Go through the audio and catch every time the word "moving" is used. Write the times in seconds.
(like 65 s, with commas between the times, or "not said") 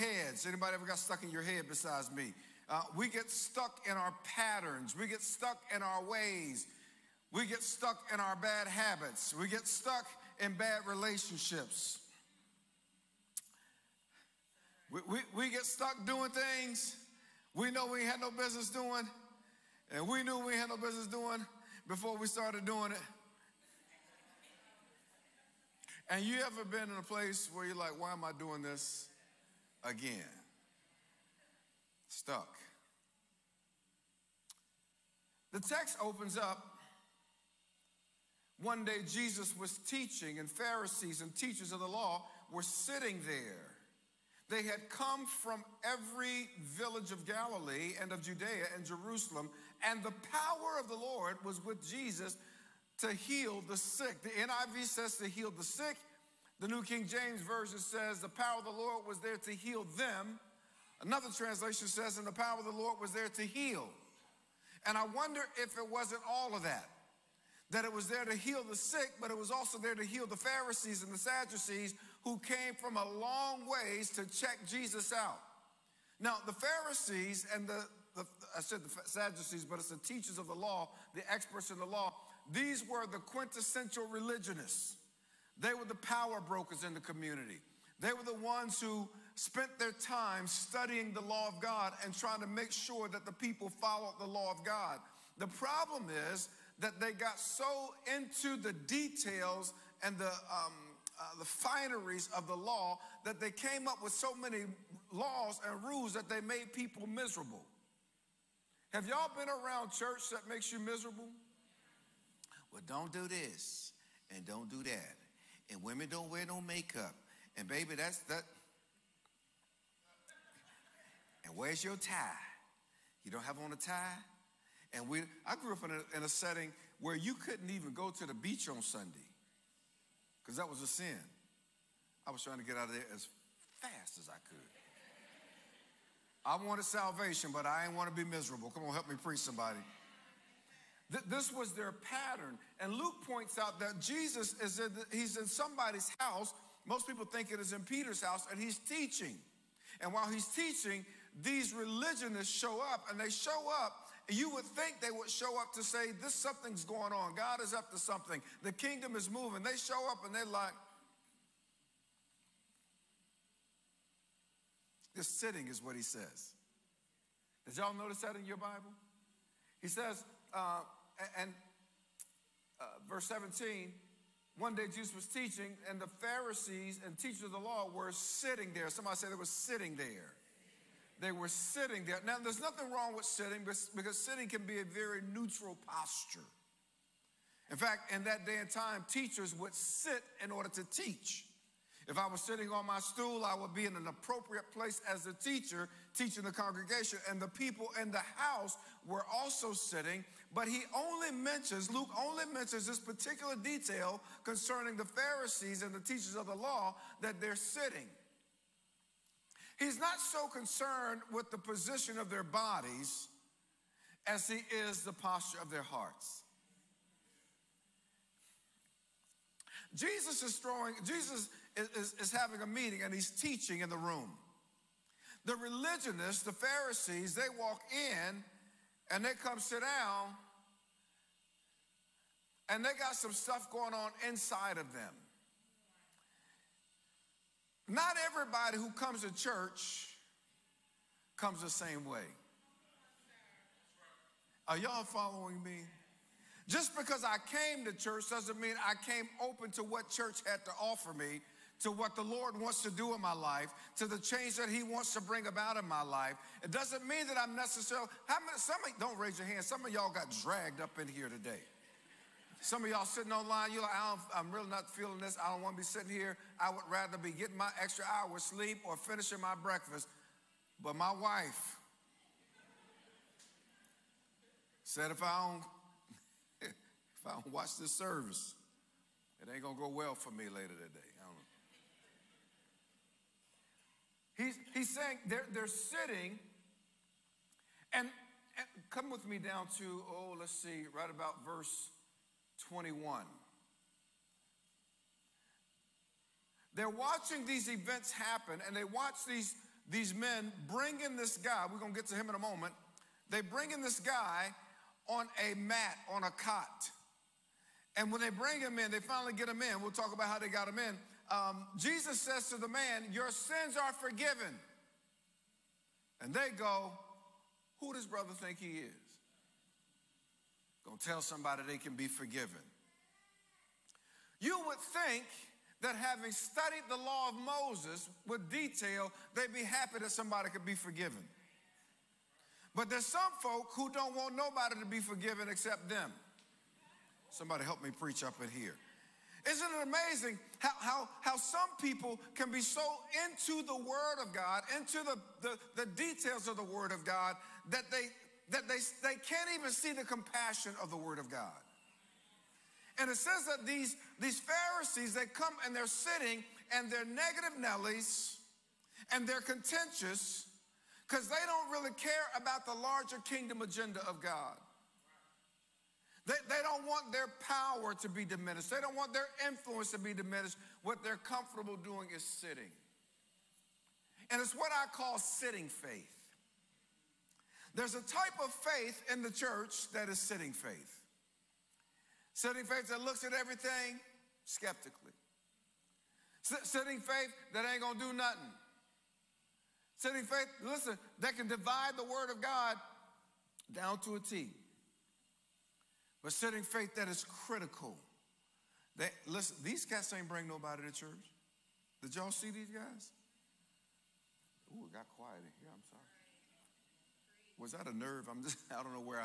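159 s.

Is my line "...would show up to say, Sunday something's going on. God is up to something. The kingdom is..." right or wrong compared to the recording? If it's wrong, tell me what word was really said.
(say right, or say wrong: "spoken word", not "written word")
wrong: "This", not "Sunday".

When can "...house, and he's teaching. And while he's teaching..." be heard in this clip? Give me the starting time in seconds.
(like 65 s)
148 s.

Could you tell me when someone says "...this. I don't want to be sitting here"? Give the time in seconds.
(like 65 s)
265 s.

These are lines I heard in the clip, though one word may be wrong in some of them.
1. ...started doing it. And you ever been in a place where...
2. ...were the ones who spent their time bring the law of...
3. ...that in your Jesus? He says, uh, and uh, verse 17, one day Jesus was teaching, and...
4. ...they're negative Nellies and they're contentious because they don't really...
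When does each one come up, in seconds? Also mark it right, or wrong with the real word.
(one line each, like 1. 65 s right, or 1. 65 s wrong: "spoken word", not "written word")
1. 22 s right
2. 88 s wrong: "studying", not "bring"
3. 168 s wrong: "Bible", not "Jesus"
4. 356 s right.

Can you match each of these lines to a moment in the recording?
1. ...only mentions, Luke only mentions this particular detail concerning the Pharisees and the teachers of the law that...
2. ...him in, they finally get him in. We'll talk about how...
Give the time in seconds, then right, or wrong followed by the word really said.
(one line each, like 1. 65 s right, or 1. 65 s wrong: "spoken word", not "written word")
1. 200 s right
2. 308 s right.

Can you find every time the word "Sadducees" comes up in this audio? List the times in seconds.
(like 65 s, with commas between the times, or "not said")
71 s, 79 s.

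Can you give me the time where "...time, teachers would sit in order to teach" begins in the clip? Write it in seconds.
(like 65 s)
188 s.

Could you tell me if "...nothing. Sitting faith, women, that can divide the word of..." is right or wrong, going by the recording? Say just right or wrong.
wrong.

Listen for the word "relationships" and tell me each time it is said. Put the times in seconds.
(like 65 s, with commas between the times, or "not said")
10 s.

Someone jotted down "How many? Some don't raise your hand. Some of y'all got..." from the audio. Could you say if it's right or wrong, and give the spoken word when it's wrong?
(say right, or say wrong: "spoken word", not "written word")
right.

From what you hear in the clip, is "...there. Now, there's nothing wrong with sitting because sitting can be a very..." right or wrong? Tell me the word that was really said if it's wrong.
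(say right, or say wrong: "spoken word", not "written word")
right.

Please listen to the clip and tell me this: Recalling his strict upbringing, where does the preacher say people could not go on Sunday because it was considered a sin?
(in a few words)
the beach.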